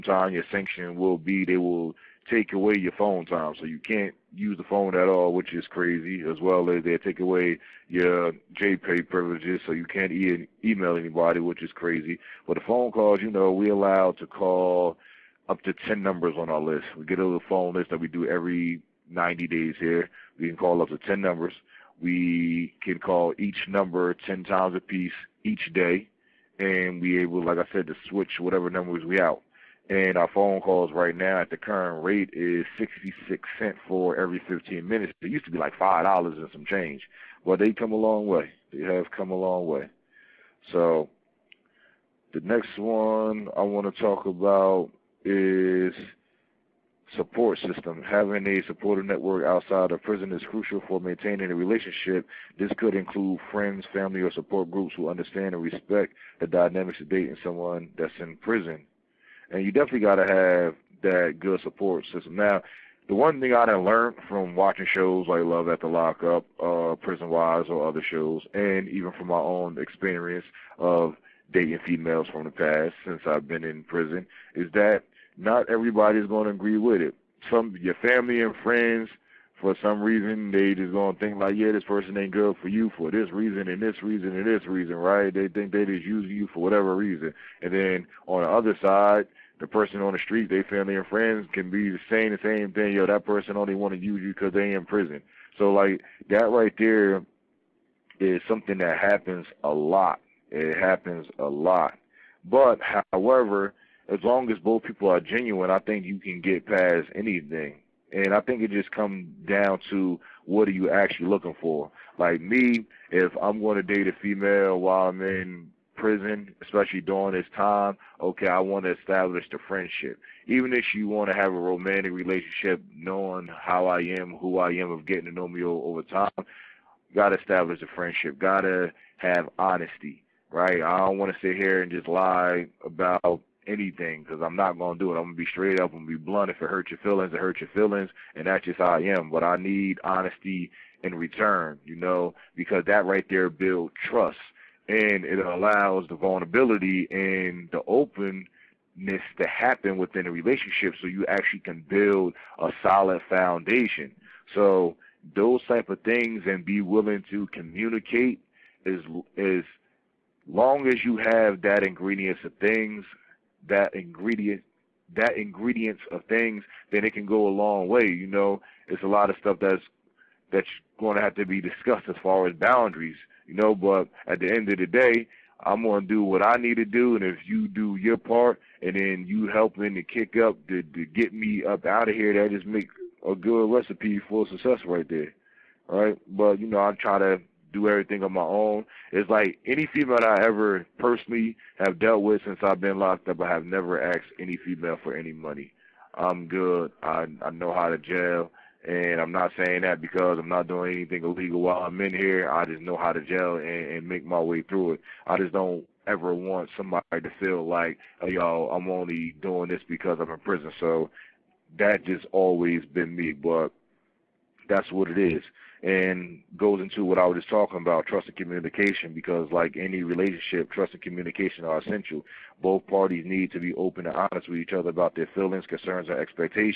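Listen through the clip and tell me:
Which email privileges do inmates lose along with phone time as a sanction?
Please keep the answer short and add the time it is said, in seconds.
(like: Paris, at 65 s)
JPay, at 8 s.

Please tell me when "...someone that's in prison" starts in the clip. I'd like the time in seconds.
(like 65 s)
57 s.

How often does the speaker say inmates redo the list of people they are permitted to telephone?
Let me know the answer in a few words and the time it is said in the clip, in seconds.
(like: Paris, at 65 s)
Every 90 days, at 18 s.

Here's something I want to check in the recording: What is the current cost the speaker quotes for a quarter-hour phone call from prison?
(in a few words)
66 cents.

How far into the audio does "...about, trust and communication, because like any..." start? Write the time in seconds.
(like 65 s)
217 s.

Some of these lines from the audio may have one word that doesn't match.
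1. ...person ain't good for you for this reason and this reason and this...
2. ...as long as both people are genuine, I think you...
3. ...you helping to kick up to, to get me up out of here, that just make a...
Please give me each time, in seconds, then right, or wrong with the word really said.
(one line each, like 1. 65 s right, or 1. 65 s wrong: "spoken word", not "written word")
1. 81 s right
2. 104 s right
3. 179 s right.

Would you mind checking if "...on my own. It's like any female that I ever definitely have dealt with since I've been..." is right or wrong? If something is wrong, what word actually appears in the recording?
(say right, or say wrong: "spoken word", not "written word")
wrong: "personally", not "definitely".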